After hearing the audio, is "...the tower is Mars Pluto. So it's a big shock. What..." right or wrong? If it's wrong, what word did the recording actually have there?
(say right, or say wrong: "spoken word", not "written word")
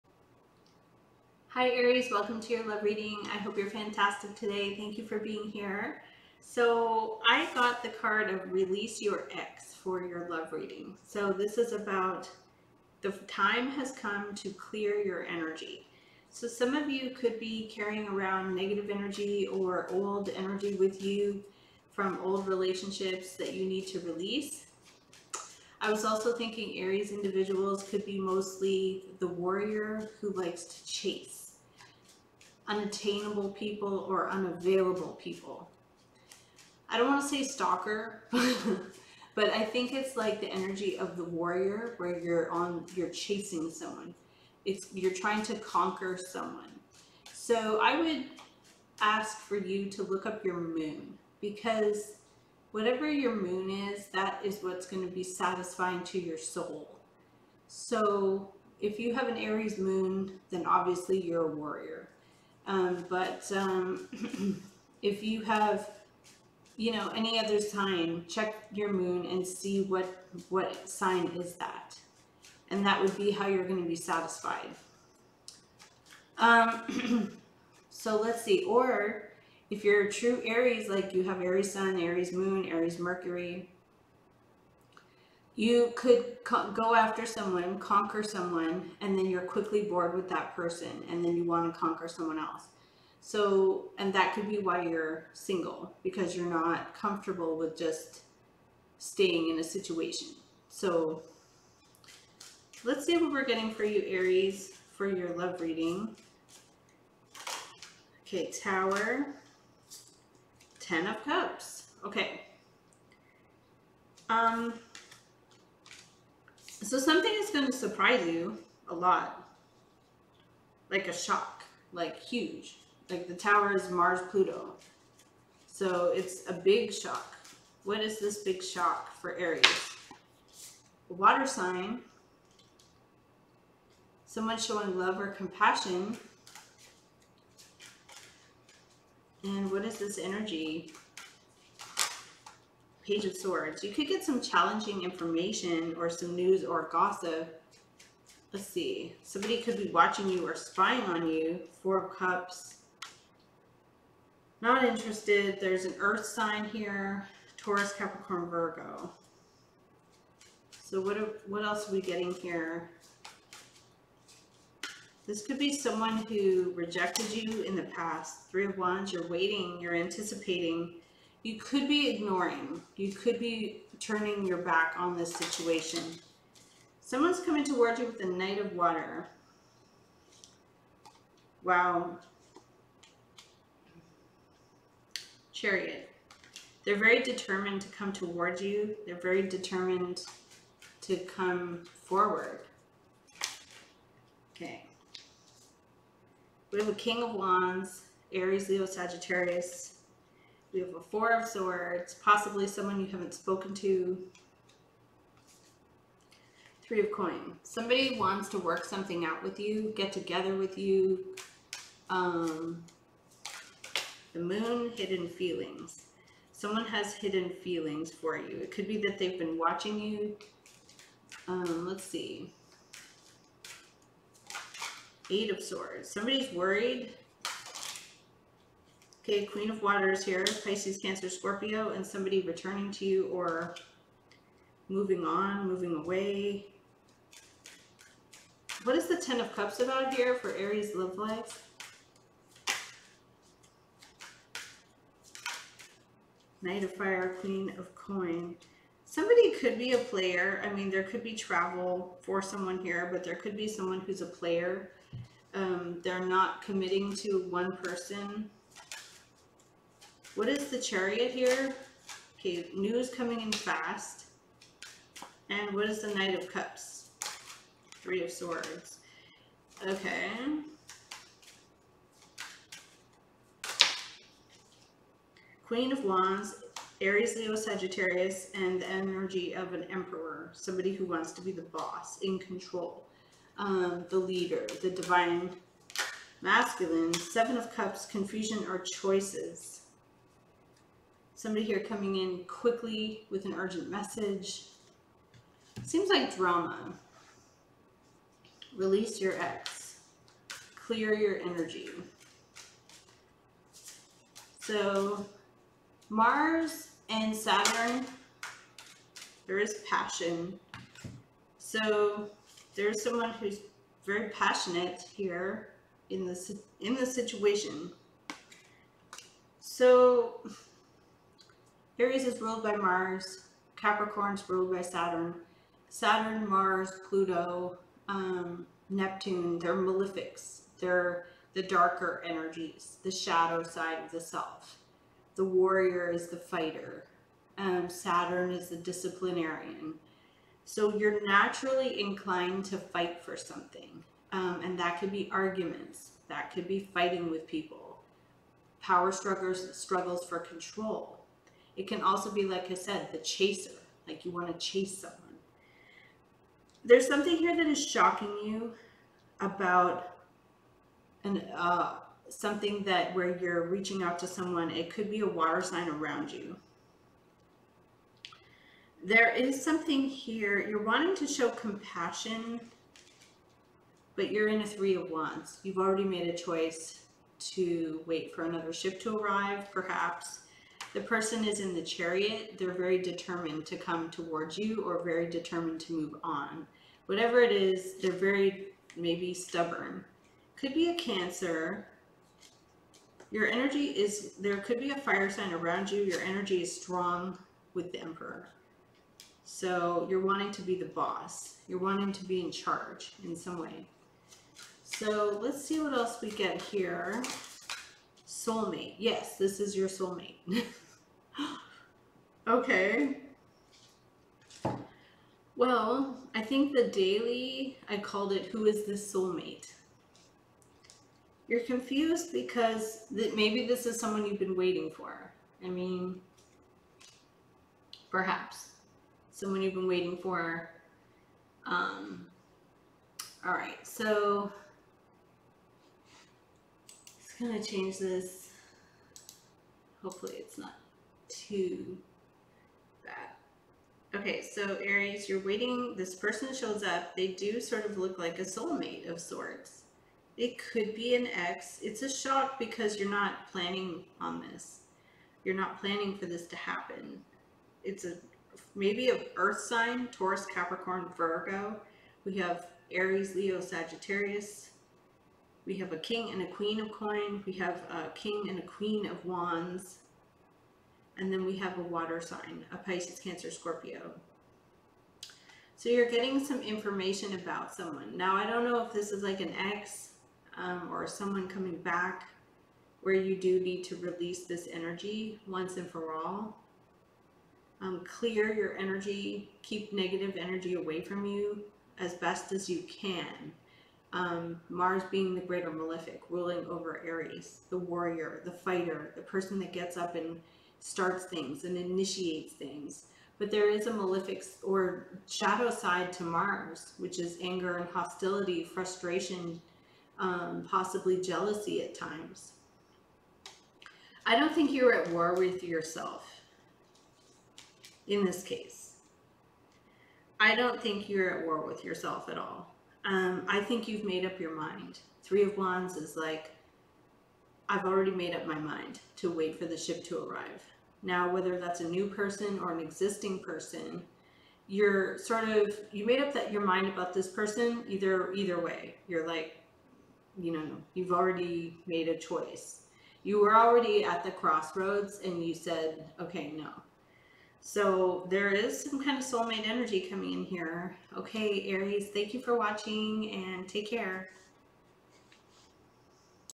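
right.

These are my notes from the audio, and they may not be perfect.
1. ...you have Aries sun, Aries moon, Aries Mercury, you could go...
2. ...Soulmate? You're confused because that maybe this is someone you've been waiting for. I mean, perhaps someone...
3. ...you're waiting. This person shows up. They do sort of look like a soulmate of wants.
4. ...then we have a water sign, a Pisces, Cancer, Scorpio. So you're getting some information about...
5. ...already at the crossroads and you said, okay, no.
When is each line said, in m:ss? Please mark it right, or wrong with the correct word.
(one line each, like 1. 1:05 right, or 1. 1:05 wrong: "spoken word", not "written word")
1. 1:21 right
2. 6:59 right
3. 7:25 wrong: "sorts", not "wants"
4. 7:51 right
5. 9:03 right.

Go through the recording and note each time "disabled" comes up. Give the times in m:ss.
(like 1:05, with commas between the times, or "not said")
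not said.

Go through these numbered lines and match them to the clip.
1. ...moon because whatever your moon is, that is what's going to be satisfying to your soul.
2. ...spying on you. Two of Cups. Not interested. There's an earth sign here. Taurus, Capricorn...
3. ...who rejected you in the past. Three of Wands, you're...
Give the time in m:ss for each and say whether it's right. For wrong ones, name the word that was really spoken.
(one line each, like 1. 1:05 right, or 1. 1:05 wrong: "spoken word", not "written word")
1. 0:50 right
2. 2:30 wrong: "Four", not "Two"
3. 2:46 right.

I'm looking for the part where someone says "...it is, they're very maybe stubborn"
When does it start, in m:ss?
6:27.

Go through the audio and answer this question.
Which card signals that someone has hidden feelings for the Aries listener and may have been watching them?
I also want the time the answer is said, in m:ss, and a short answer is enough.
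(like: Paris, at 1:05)
The Moon, at 3:34.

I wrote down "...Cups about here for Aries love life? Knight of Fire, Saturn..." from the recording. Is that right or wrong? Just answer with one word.
wrong.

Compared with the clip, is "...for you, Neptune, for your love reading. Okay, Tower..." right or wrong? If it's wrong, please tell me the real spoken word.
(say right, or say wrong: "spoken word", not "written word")
wrong: "Aries", not "Neptune".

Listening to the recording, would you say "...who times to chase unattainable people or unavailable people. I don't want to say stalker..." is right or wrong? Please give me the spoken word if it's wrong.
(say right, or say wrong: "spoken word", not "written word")
wrong: "likes", not "times".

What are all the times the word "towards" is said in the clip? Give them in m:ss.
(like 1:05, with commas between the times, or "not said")
2:57, 3:08, 6:24.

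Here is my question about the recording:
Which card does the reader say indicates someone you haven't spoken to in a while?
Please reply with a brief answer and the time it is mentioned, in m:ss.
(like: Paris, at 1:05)
Four of Swords, at 3:21.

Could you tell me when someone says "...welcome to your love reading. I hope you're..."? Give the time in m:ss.
0:02.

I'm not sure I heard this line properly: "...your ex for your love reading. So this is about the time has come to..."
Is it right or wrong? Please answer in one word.
right.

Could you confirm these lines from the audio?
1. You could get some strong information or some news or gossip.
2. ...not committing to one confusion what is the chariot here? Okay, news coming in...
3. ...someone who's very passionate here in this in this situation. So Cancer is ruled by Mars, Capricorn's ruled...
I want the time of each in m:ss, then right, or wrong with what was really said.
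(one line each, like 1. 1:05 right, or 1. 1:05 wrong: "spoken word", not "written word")
1. 2:23 wrong: "challenging", not "strong"
2. 4:16 wrong: "person", not "confusion"
3. 5:13 wrong: "Aries", not "Cancer".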